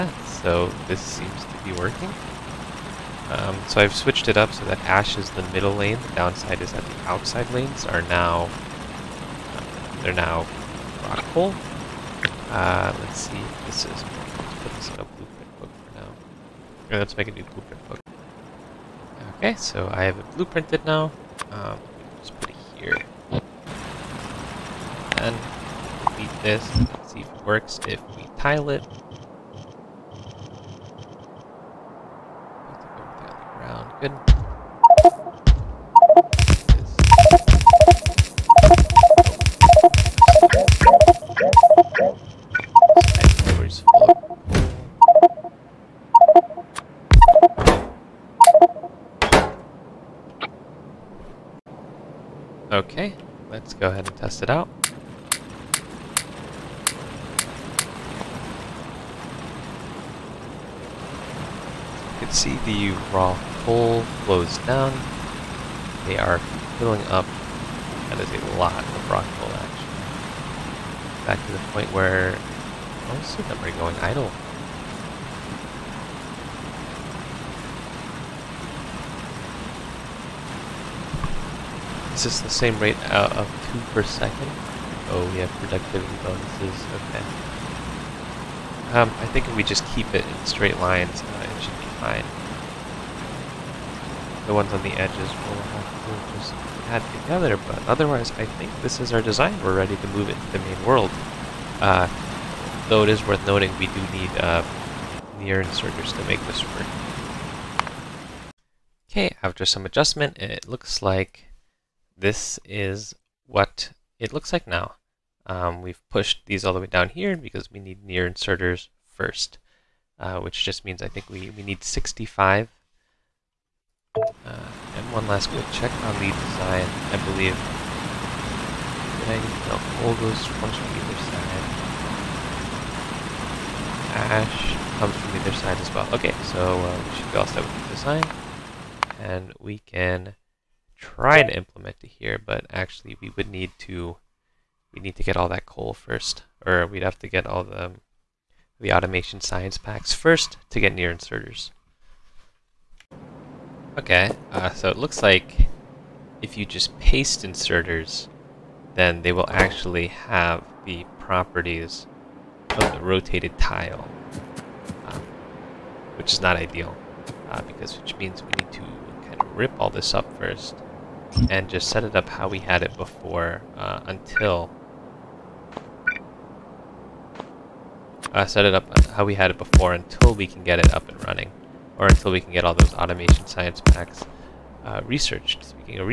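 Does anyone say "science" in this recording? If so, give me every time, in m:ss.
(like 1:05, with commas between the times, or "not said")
2:29, 3:03.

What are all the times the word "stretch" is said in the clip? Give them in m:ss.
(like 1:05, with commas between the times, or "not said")
not said.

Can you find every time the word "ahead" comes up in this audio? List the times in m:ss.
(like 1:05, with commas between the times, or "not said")
0:53.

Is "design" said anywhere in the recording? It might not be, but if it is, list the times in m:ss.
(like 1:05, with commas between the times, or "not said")
1:39, 2:06, 2:17.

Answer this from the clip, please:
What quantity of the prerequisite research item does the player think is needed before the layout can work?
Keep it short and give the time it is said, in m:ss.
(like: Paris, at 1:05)
65, at 2:01.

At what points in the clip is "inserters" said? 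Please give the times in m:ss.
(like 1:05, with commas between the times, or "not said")
1:45, 1:58, 2:31, 2:37.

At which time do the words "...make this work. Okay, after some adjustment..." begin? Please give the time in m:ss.
1:46.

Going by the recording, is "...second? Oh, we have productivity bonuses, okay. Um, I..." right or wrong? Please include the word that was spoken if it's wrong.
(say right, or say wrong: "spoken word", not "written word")
right.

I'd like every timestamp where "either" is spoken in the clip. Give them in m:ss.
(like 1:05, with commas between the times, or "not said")
2:10, 2:15.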